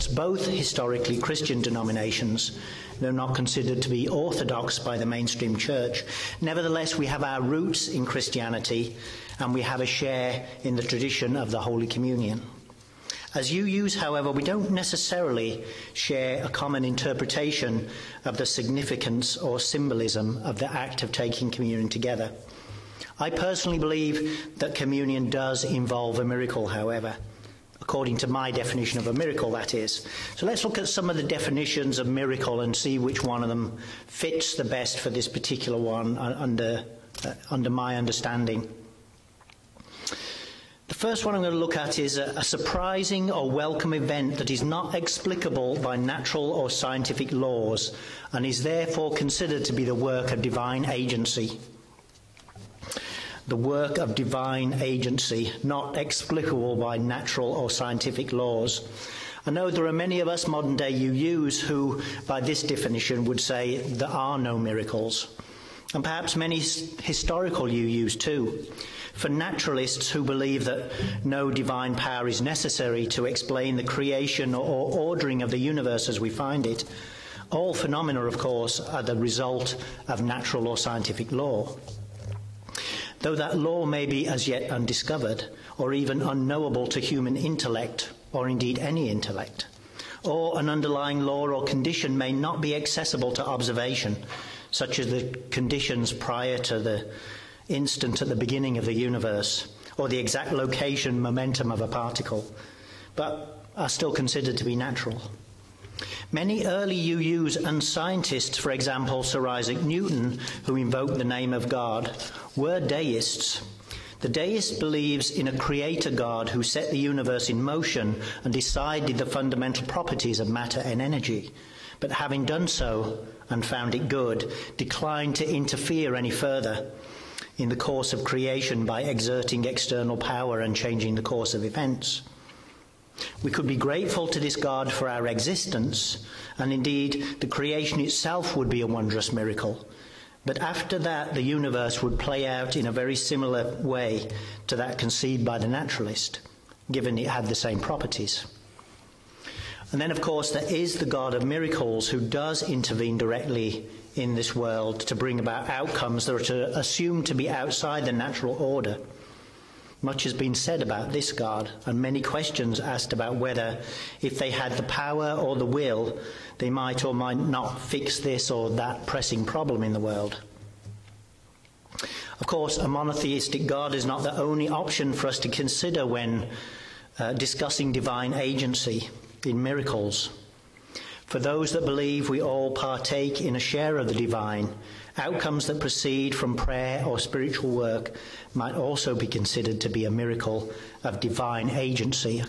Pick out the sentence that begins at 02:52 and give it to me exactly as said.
Of course, a monotheistic God is not the only option for us to consider when uh, discussing divine agency in miracles.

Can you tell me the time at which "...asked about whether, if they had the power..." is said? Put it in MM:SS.
02:42.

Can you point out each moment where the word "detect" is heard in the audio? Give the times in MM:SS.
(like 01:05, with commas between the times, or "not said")
not said.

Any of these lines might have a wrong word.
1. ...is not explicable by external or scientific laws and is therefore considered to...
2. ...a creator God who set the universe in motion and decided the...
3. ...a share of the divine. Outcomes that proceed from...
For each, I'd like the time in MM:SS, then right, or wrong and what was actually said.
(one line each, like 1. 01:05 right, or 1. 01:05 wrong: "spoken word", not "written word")
1. 00:44 wrong: "natural", not "external"
2. 01:55 right
3. 03:03 right.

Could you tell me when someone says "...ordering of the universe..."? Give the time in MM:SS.
01:14.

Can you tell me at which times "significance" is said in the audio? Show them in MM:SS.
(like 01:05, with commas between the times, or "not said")
00:18.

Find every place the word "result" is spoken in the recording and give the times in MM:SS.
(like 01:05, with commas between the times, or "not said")
01:19.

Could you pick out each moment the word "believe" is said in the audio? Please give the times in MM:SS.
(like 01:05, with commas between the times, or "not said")
00:23, 01:10, 01:54, 03:01.